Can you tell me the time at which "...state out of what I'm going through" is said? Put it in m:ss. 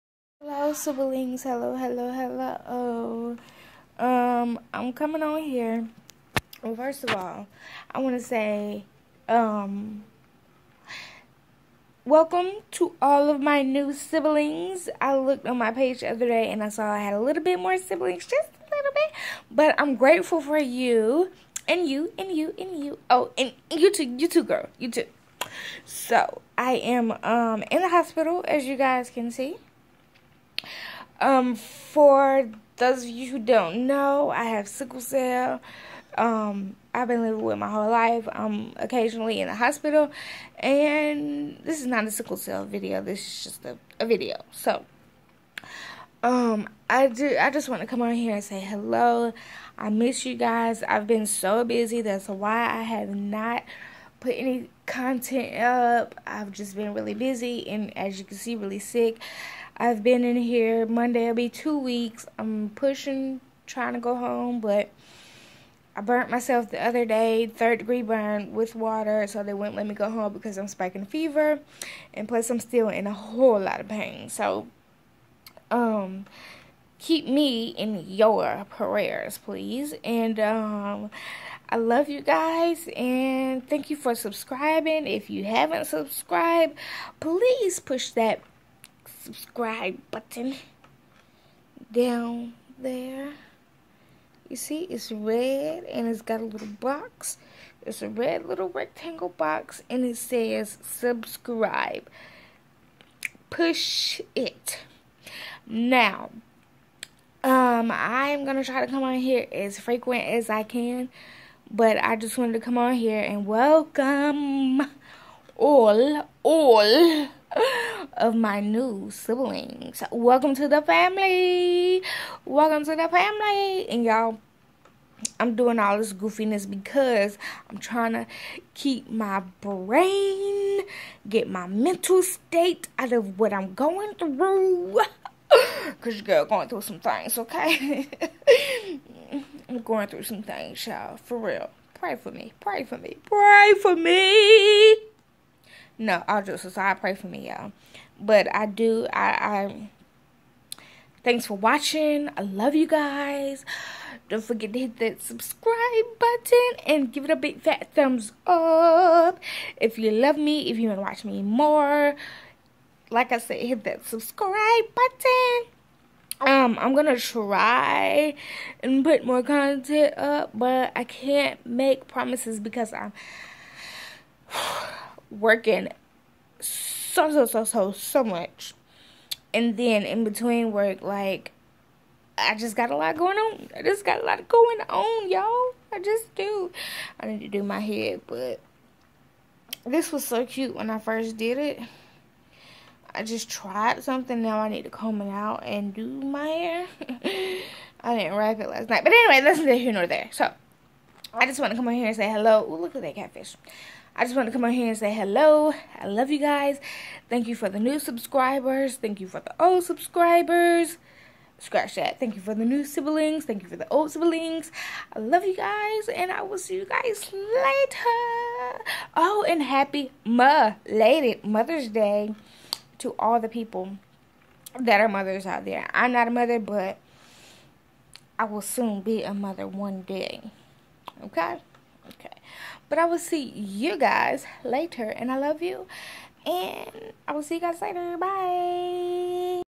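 2:12.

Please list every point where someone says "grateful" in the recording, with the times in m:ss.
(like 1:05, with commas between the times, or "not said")
0:19.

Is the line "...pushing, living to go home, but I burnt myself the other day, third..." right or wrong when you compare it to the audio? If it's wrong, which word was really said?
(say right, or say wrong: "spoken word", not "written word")
wrong: "trying", not "living".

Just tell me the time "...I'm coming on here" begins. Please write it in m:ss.
0:04.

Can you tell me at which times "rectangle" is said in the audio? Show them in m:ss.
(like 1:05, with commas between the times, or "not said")
1:38.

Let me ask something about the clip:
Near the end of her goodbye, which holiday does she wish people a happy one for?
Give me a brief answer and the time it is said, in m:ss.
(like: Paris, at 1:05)
Mother's Day, at 3:41.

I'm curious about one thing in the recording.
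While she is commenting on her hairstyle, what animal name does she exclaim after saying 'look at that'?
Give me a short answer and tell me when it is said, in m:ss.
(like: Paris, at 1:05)
catfish, at 3:23.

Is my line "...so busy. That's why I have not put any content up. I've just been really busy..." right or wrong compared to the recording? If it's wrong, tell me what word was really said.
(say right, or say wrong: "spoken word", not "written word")
right.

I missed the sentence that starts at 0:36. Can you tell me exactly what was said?
Um, I've been living with my whole life.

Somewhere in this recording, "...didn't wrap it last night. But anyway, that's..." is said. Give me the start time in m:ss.
3:18.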